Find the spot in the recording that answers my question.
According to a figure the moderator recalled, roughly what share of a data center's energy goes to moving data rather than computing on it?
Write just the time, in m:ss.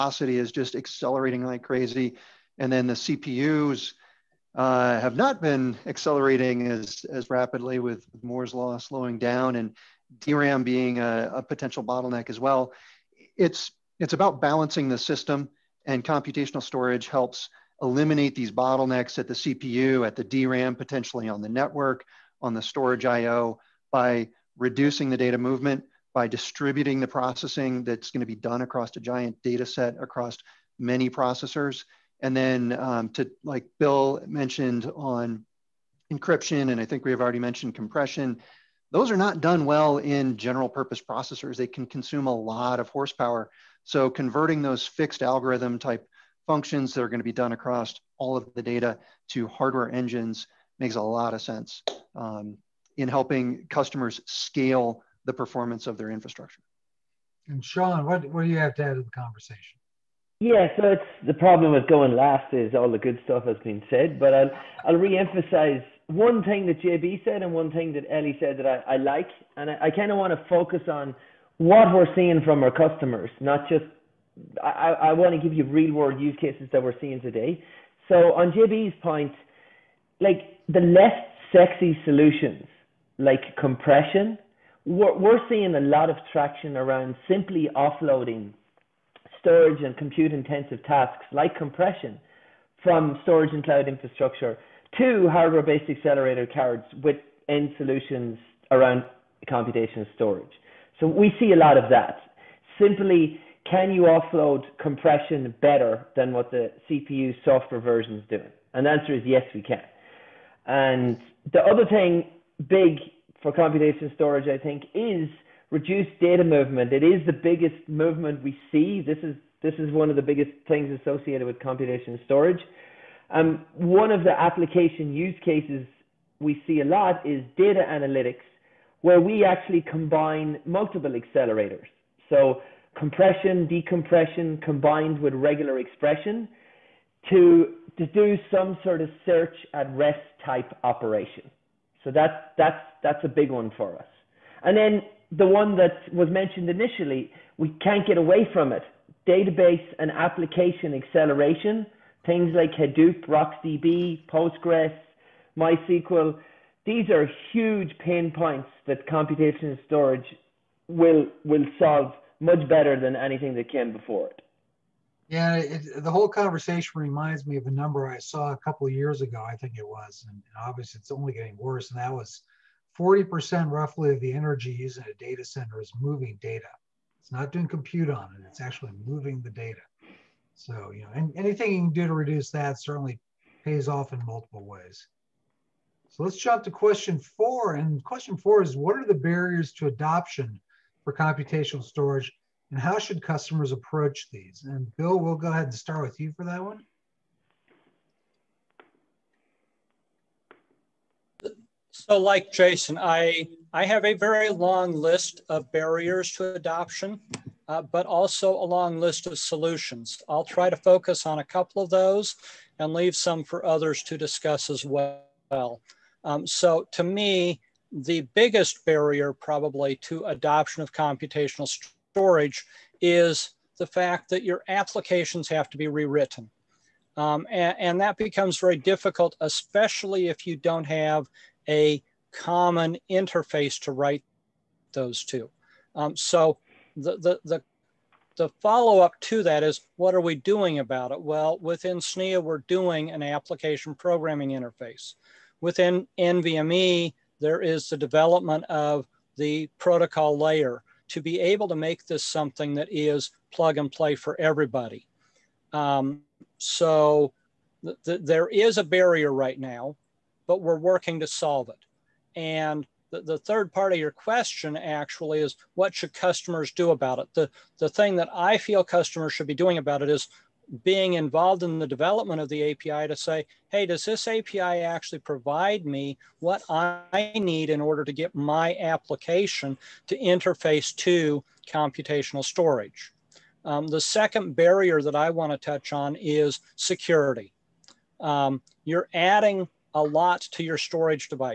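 2:52.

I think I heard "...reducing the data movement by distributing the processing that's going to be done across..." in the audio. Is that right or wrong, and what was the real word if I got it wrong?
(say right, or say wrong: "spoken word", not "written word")
right.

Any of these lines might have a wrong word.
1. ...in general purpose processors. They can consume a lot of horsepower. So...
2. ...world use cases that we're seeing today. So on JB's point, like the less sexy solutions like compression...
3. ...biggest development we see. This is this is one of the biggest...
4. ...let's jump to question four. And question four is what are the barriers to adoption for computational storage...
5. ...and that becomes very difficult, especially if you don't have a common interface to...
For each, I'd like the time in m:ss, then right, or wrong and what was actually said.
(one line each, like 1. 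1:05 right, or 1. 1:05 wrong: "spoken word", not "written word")
1. 0:39 right
2. 1:15 right
3. 1:57 wrong: "movement", not "development"
4. 3:06 right
5. 3:47 right.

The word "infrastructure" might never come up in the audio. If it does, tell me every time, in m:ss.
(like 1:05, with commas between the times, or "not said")
0:56, 1:33.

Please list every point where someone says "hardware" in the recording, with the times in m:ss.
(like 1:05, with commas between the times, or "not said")
0:49, 1:35.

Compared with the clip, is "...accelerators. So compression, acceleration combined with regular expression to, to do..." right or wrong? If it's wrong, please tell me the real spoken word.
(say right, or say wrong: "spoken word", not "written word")
wrong: "decompression", not "acceleration".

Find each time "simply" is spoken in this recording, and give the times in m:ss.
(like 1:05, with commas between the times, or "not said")
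1:27, 1:42.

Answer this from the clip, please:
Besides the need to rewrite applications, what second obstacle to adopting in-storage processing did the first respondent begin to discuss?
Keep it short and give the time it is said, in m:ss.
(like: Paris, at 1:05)
Security, at 4:46.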